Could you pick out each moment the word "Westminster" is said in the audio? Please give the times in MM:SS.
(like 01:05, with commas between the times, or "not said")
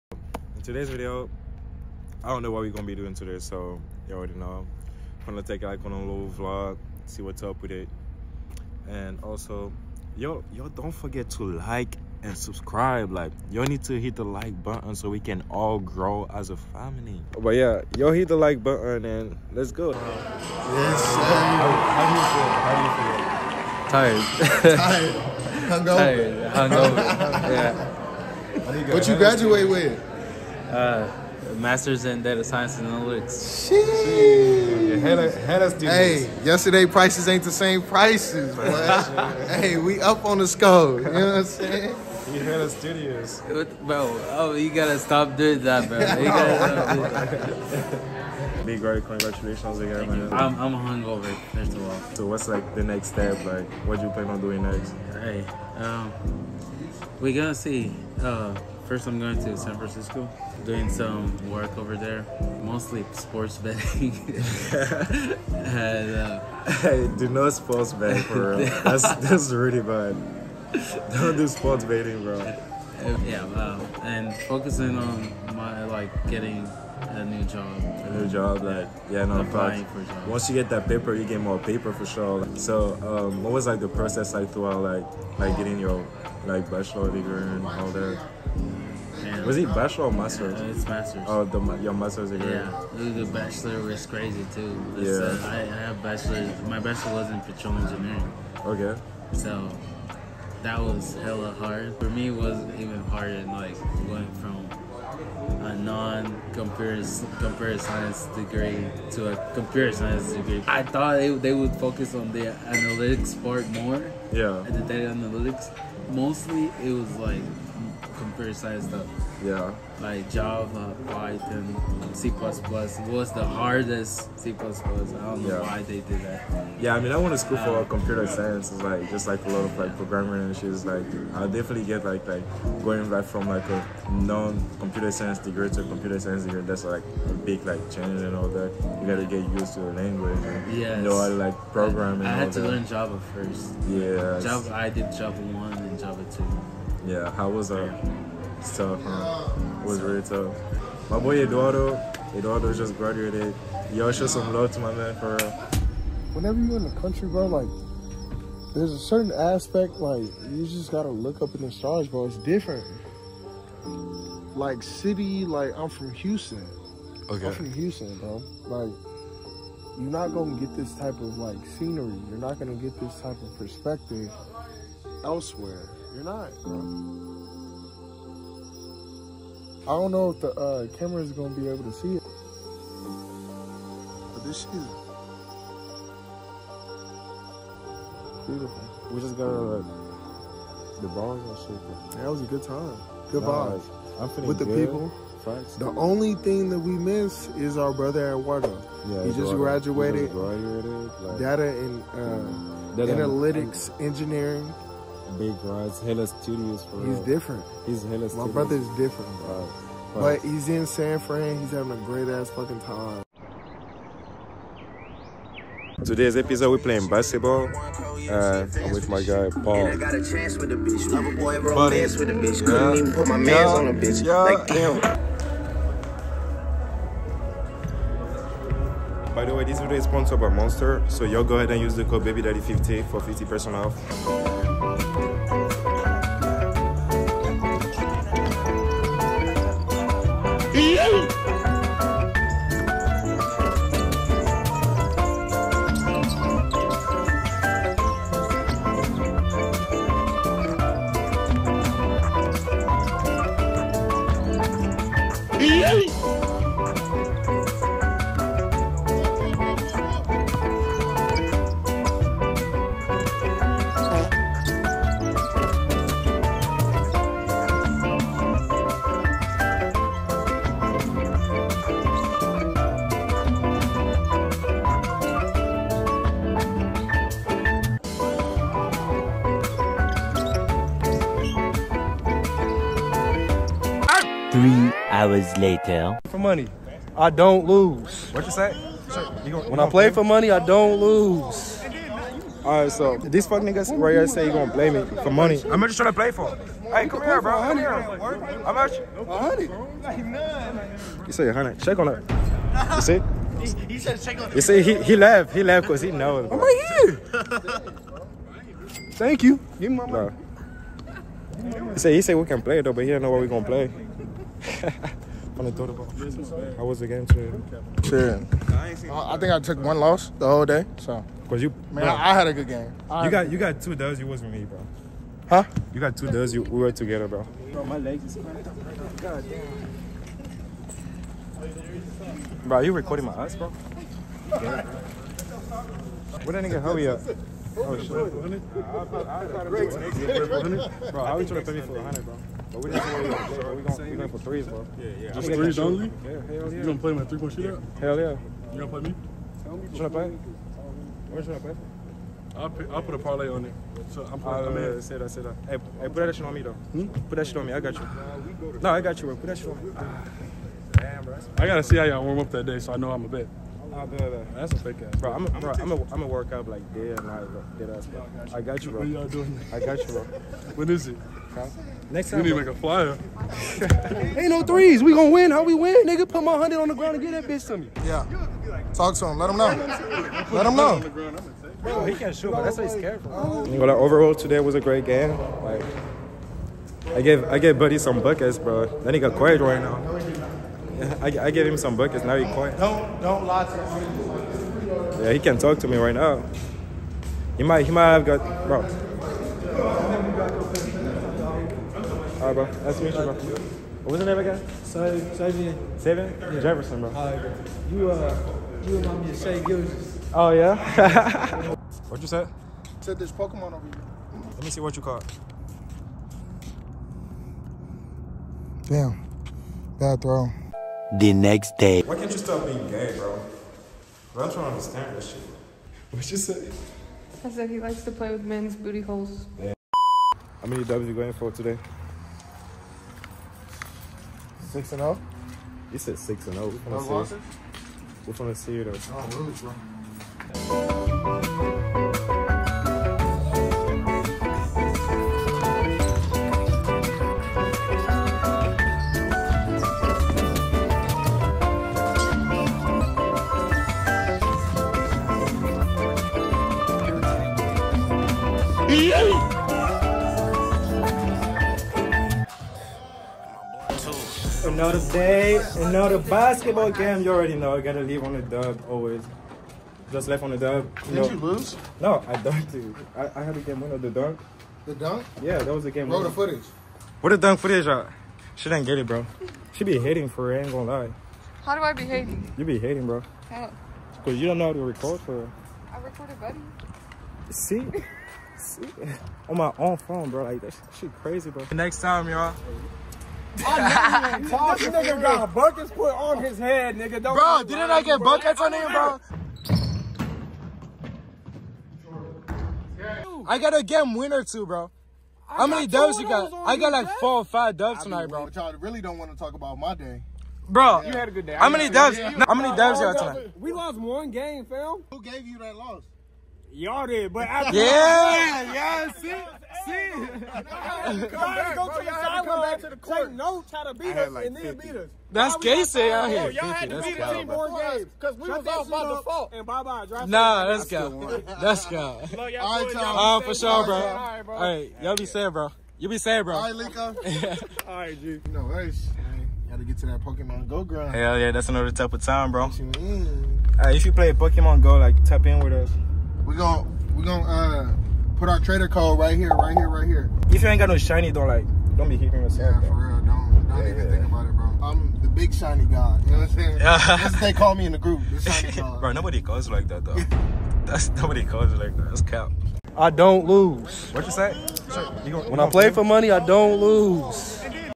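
not said.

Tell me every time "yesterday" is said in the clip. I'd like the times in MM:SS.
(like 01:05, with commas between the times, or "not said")
00:36.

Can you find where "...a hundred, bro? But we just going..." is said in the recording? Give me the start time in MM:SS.
05:41.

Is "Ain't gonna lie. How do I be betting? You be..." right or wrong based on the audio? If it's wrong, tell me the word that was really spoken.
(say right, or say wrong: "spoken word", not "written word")
wrong: "hating", not "betting".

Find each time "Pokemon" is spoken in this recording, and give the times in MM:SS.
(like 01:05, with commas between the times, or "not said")
06:53, 09:00, 09:04.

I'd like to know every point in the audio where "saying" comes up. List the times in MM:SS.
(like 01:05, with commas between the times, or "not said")
00:41, 09:16.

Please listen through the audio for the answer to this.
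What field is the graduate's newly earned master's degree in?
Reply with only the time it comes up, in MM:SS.
00:32.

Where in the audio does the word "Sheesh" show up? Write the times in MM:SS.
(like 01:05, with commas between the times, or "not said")
00:33.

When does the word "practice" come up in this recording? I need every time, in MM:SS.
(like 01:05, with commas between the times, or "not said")
not said.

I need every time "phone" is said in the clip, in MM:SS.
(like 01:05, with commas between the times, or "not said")
08:09.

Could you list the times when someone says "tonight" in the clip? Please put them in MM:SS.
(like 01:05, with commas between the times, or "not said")
08:28, 08:33.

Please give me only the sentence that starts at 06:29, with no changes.
Then he got quiet right now.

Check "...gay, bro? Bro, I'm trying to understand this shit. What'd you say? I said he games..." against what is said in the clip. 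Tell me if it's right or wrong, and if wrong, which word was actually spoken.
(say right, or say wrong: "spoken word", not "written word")
wrong: "likes", not "games".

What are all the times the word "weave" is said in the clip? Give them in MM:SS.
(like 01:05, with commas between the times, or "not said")
not said.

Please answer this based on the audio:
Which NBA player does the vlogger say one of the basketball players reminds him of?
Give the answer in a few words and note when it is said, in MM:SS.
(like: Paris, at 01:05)
Shai Gilgeous, at 06:49.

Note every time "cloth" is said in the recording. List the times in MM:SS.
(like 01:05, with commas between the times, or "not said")
not said.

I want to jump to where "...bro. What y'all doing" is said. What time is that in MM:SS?
06:08.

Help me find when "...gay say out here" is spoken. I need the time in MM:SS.
08:45.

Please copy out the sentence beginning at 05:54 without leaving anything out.
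So I'm putting uh, i said I said that, Hey, hey, put that shit on me, though.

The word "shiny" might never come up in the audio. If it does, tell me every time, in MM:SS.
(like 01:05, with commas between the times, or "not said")
09:10, 09:15.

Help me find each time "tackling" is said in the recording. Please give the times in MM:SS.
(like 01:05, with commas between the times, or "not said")
not said.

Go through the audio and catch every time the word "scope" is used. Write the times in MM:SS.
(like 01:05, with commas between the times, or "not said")
00:40.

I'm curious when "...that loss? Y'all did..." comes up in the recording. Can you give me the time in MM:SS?
08:35.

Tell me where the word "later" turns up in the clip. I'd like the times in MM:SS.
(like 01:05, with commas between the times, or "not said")
04:45.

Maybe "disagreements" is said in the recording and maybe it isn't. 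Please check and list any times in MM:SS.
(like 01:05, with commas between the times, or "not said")
not said.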